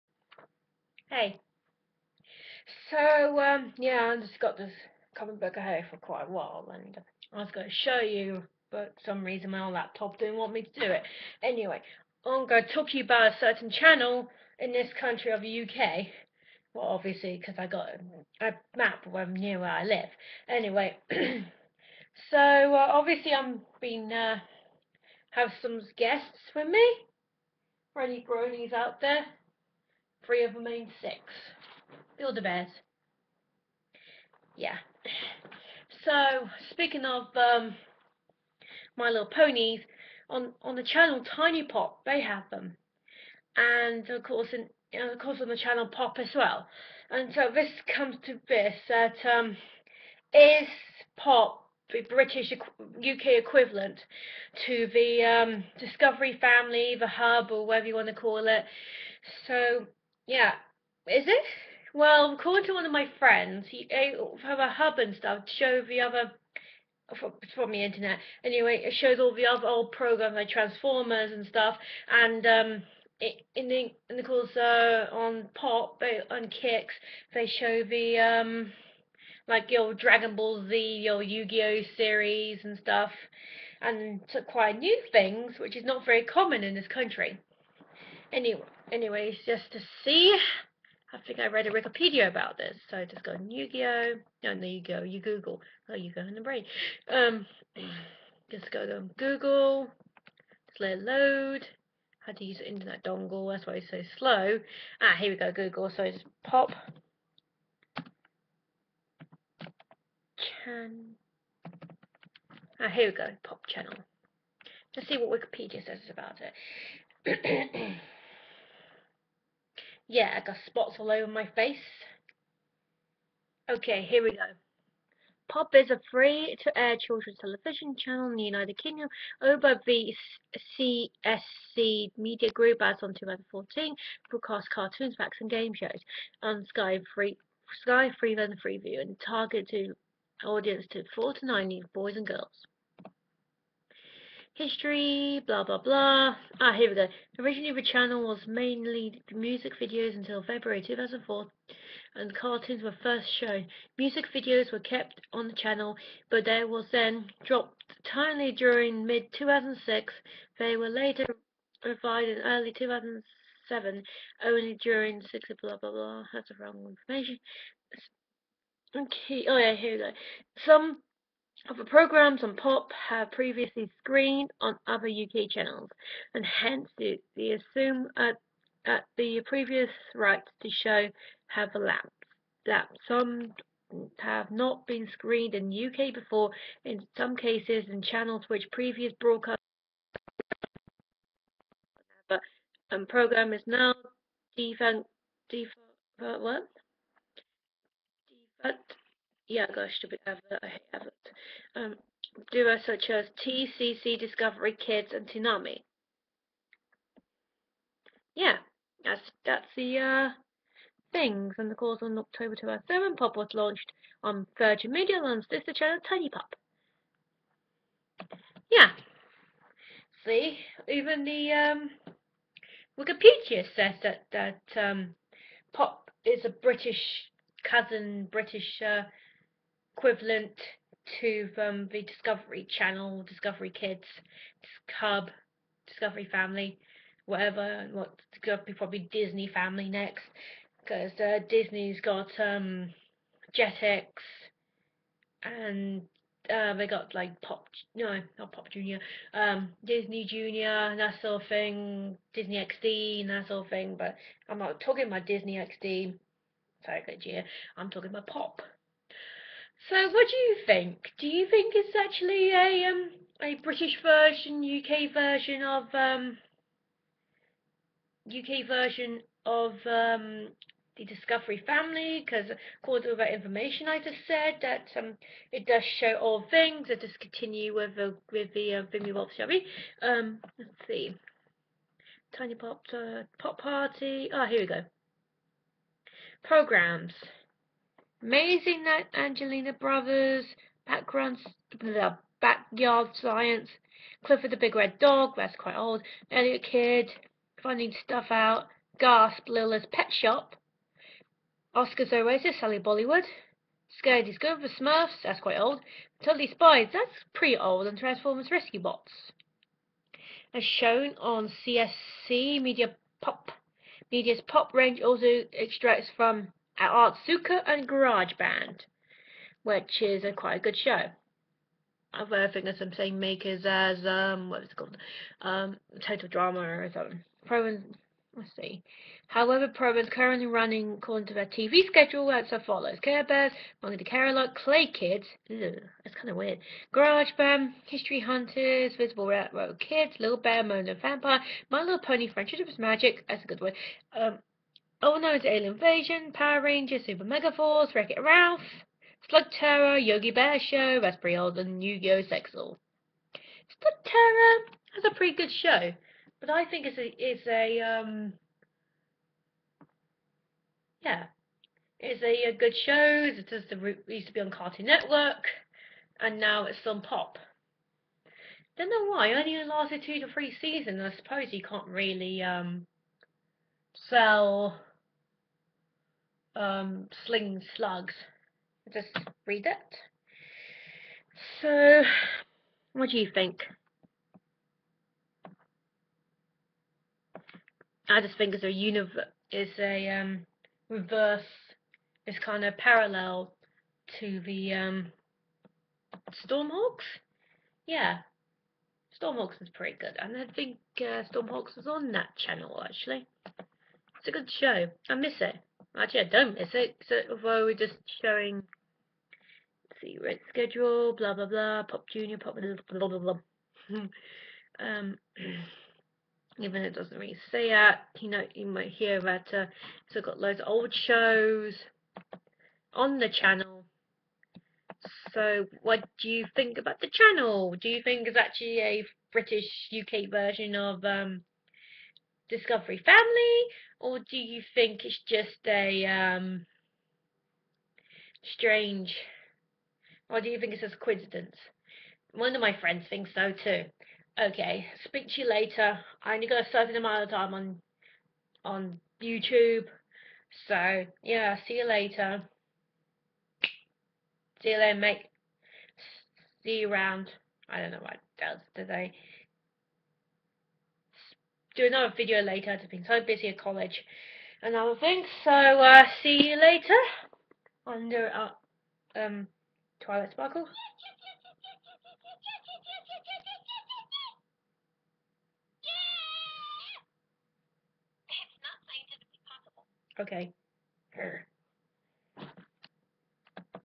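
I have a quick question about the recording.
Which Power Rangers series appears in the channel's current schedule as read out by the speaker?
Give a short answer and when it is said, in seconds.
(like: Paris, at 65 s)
Super Mega Force, at 347 s.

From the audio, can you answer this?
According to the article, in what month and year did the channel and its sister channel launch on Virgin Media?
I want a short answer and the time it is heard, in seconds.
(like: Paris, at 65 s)
October 2007, at 212 s.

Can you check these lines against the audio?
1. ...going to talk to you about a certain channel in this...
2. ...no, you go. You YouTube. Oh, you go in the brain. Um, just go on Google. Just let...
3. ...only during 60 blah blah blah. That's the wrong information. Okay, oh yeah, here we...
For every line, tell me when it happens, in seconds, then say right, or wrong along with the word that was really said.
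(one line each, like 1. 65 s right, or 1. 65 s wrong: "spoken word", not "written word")
1. 12 s right
2. 94 s wrong: "Google", not "YouTube"
3. 164 s right.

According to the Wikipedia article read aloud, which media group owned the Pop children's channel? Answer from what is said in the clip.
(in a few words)
CSC Media Group.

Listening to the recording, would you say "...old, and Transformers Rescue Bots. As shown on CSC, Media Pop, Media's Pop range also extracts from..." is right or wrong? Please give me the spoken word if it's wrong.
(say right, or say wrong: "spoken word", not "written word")
right.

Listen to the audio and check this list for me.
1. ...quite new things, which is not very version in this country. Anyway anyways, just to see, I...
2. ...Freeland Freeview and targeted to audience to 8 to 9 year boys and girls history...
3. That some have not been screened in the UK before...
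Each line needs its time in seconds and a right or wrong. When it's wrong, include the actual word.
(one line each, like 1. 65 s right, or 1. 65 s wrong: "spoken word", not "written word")
1. 84 s wrong: "common", not "version"
2. 138 s wrong: "4", not "8"
3. 182 s right.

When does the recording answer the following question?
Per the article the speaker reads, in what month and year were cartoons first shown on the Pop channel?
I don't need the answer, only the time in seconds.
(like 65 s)
150 s.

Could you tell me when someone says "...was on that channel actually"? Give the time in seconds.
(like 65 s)
401 s.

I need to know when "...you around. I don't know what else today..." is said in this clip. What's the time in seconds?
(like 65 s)
456 s.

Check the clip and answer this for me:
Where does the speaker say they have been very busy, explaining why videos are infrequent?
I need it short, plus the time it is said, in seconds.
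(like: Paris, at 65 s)
college, at 463 s.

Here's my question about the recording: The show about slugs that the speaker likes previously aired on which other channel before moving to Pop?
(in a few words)
Cartoon Network.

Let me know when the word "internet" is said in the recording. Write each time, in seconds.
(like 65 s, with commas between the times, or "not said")
67 s, 102 s.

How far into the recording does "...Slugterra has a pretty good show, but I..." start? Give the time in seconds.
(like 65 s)
353 s.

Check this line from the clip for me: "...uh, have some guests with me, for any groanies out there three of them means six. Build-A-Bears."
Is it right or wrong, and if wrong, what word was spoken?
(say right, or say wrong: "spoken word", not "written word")
right.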